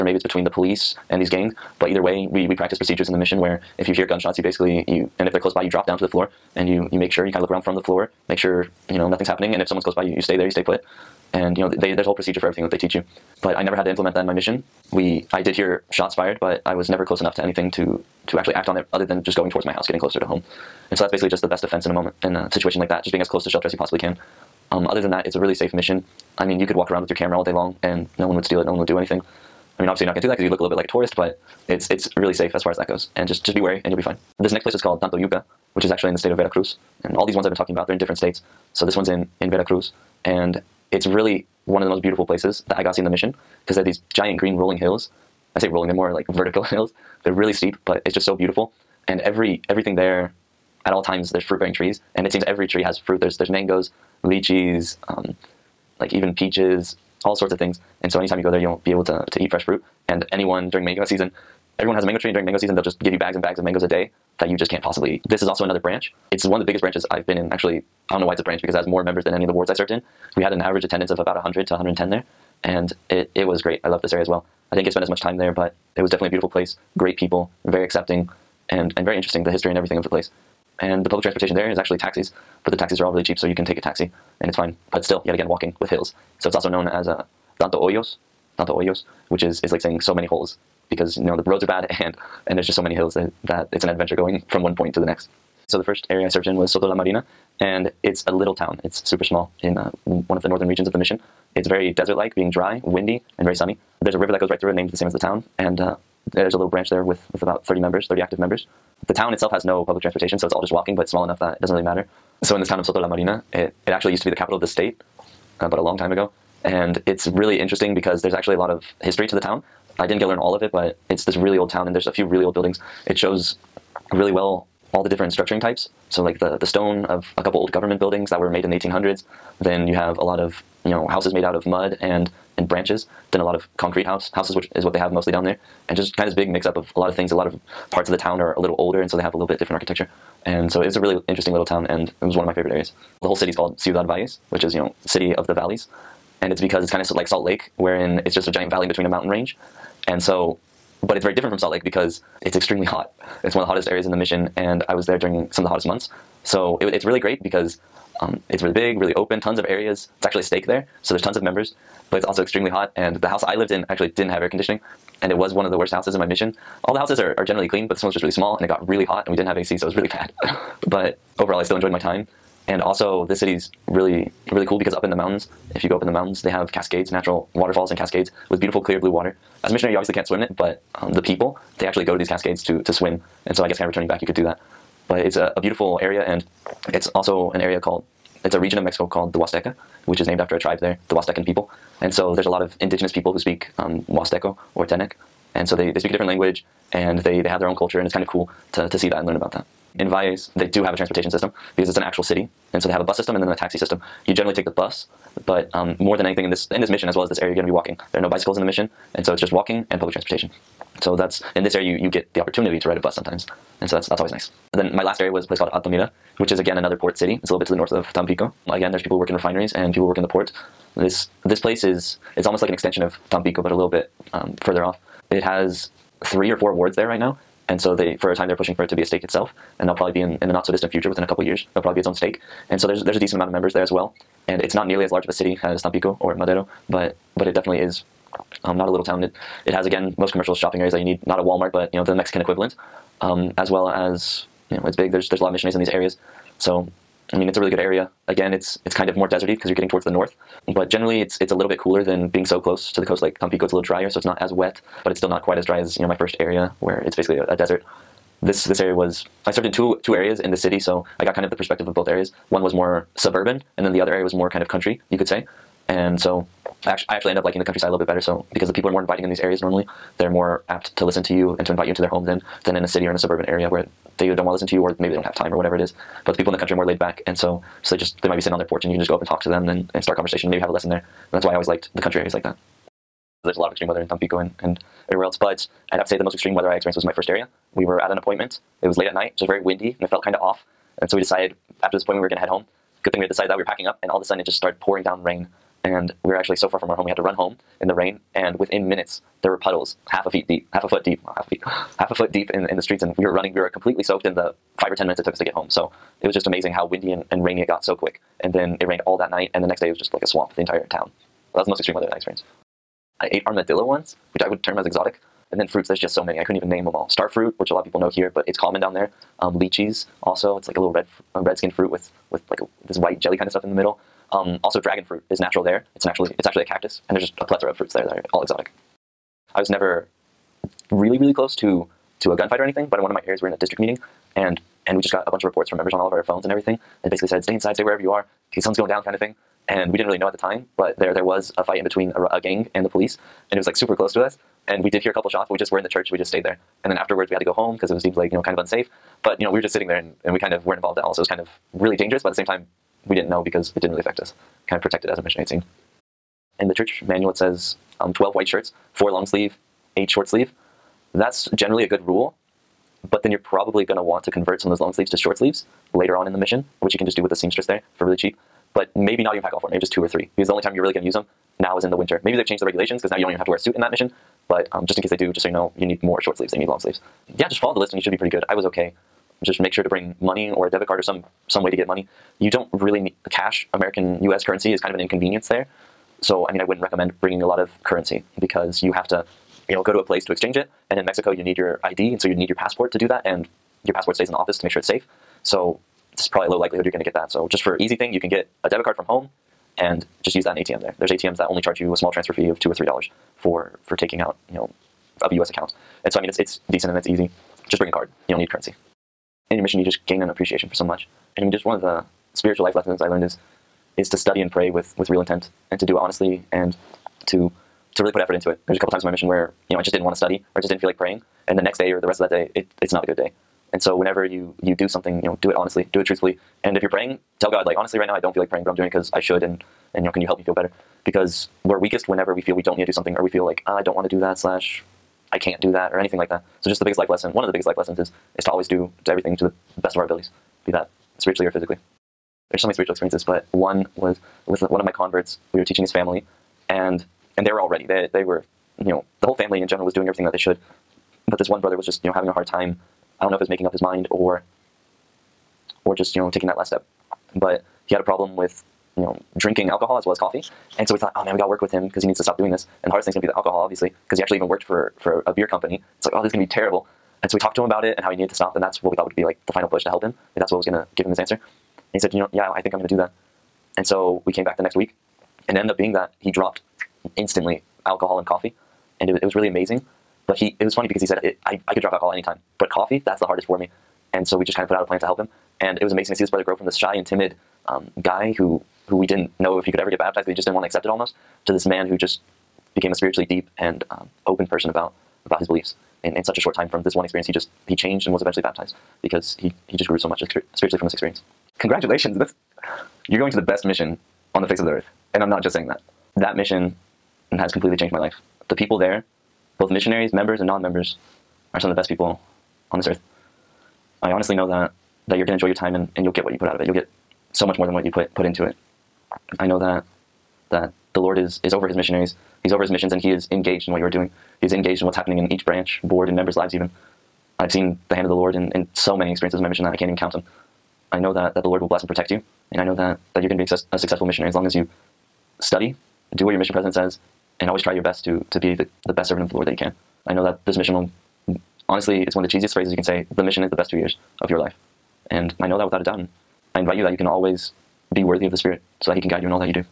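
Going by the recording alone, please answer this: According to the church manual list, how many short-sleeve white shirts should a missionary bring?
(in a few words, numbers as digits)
8.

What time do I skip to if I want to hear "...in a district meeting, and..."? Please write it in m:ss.
5:33.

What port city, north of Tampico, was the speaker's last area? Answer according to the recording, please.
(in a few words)
Altamira.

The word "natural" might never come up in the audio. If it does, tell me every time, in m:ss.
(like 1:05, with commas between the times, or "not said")
2:57, 5:25.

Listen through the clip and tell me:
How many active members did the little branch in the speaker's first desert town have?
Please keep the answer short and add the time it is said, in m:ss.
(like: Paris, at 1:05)
30, at 1:48.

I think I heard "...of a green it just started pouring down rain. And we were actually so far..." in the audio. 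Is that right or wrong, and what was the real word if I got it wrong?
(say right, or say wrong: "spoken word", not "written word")
wrong: "sudden", not "green".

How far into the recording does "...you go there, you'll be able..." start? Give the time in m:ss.
0:58.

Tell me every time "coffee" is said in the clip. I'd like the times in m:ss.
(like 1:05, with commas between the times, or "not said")
7:40, 7:58, 8:02.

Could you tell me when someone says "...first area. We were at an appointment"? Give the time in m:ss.
4:47.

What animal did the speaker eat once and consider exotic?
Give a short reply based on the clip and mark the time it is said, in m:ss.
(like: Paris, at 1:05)
Armadillo, at 5:13.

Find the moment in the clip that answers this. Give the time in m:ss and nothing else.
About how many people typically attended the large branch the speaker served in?
1:11.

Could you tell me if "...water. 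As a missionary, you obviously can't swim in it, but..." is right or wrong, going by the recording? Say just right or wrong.
right.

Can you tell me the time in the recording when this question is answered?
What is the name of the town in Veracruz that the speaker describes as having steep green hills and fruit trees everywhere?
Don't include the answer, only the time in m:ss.
0:35.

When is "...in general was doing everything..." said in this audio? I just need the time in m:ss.
7:29.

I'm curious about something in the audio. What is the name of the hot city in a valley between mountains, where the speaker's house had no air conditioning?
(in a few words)
Ciudad Valles.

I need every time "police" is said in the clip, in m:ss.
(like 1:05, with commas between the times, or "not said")
0:00, 5:42.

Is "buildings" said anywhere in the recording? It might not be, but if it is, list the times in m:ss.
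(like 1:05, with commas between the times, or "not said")
2:02, 2:08.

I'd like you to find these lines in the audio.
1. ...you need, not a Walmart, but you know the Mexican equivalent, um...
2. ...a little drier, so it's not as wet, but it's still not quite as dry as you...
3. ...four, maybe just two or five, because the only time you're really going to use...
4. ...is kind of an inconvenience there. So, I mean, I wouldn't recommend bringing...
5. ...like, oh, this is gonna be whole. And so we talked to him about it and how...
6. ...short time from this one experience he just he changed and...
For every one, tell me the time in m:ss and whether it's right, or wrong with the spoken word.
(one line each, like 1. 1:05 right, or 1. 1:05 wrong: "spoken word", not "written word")
1. 4:01 right
2. 4:13 right
3. 6:09 wrong: "three", not "five"
4. 6:24 right
5. 7:46 wrong: "terrible", not "whole"
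6. 8:16 right.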